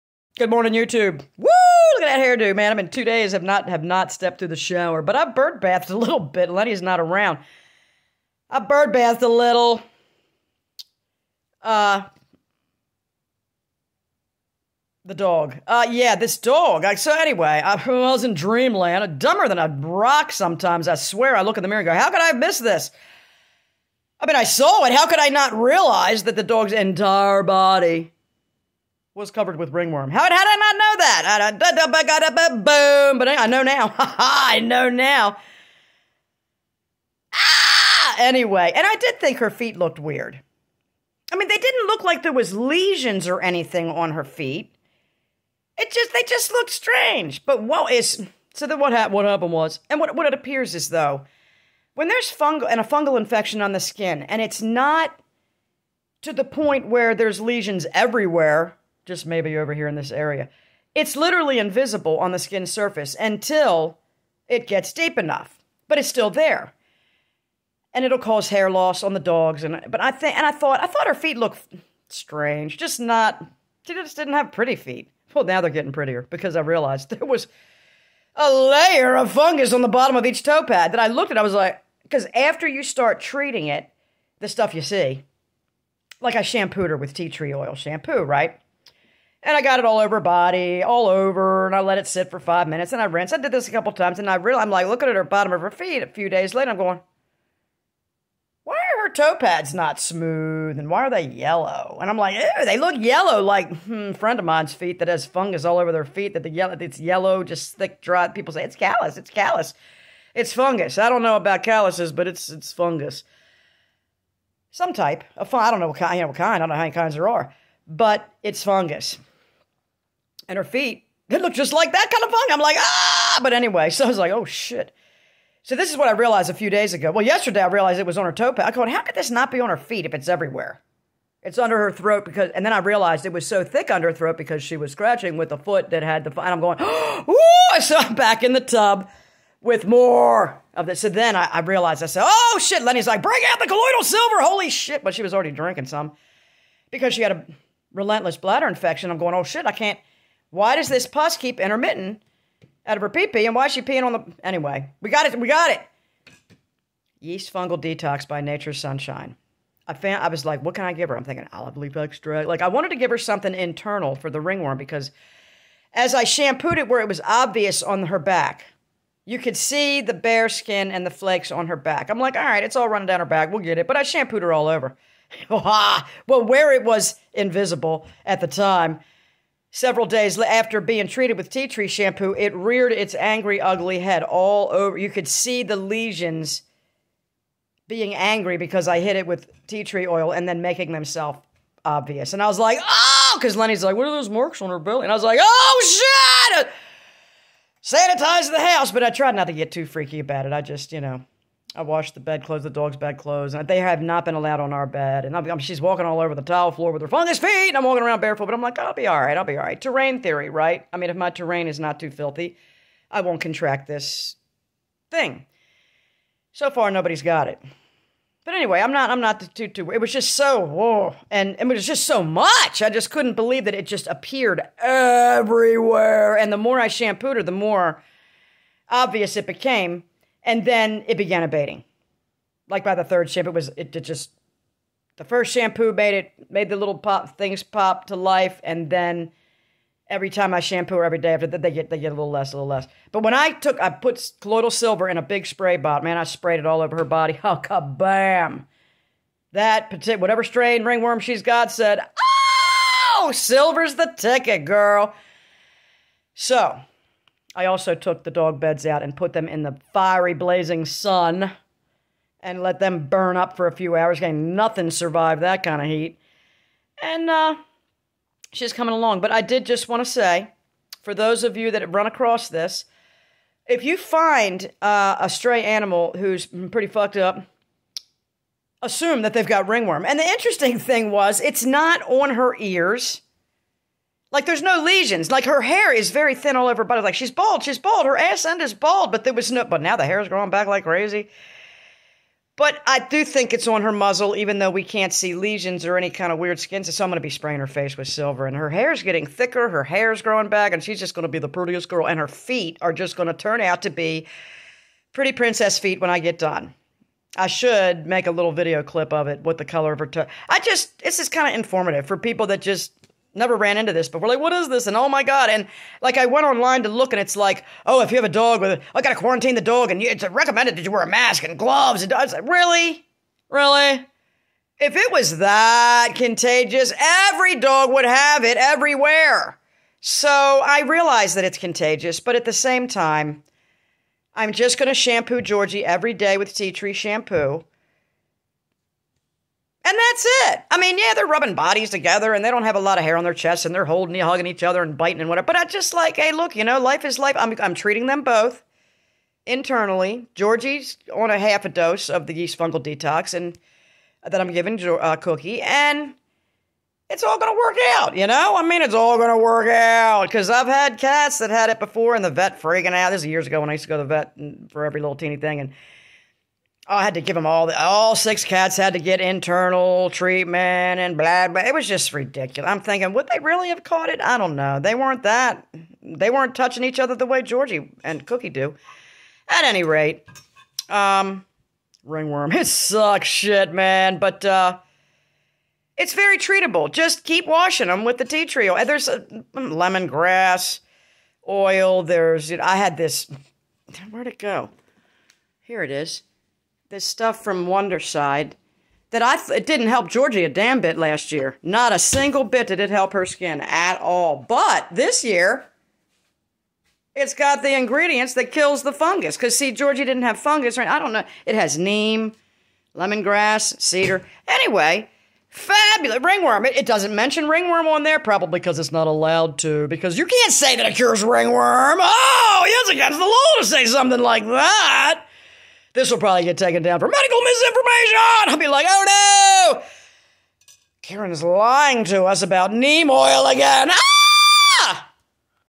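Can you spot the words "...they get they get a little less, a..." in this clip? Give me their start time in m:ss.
4:01.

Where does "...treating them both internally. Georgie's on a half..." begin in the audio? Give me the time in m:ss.
5:47.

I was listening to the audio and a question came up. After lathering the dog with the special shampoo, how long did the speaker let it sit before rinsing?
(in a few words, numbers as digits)
5 minutes.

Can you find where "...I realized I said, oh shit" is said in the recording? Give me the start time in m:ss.
2:21.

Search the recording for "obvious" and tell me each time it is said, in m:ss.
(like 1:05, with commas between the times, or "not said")
2:47, 3:11, 3:48.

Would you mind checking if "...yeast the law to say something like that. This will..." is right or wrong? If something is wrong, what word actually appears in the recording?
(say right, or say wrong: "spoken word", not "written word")
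wrong: "against", not "yeast".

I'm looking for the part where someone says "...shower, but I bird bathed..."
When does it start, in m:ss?
0:04.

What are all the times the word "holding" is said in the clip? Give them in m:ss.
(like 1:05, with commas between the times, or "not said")
5:43.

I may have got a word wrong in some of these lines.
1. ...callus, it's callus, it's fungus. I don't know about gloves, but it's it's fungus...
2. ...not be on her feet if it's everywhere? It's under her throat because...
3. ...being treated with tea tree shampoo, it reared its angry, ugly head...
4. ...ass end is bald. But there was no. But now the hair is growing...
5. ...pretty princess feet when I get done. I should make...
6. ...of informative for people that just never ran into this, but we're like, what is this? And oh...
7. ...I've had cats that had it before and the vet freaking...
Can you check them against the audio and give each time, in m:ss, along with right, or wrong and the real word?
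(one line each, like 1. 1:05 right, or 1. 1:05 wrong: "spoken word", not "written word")
1. 1:48 wrong: "calluses", not "gloves"
2. 2:09 right
3. 3:00 right
4. 4:48 right
5. 5:05 right
6. 5:11 right
7. 6:00 right.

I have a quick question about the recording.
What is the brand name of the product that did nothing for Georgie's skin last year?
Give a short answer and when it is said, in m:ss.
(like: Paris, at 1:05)
Wondercide, at 6:37.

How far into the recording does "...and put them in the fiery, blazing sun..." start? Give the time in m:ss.
4:19.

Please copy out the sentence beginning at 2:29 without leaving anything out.
I'm going, oh shit, I can't.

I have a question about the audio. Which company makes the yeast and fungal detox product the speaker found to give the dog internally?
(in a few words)
Nature's Sunshine.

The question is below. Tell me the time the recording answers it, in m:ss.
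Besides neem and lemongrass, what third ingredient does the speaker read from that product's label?
6:53.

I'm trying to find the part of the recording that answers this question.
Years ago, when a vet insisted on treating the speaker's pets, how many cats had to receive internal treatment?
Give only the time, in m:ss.
6:08.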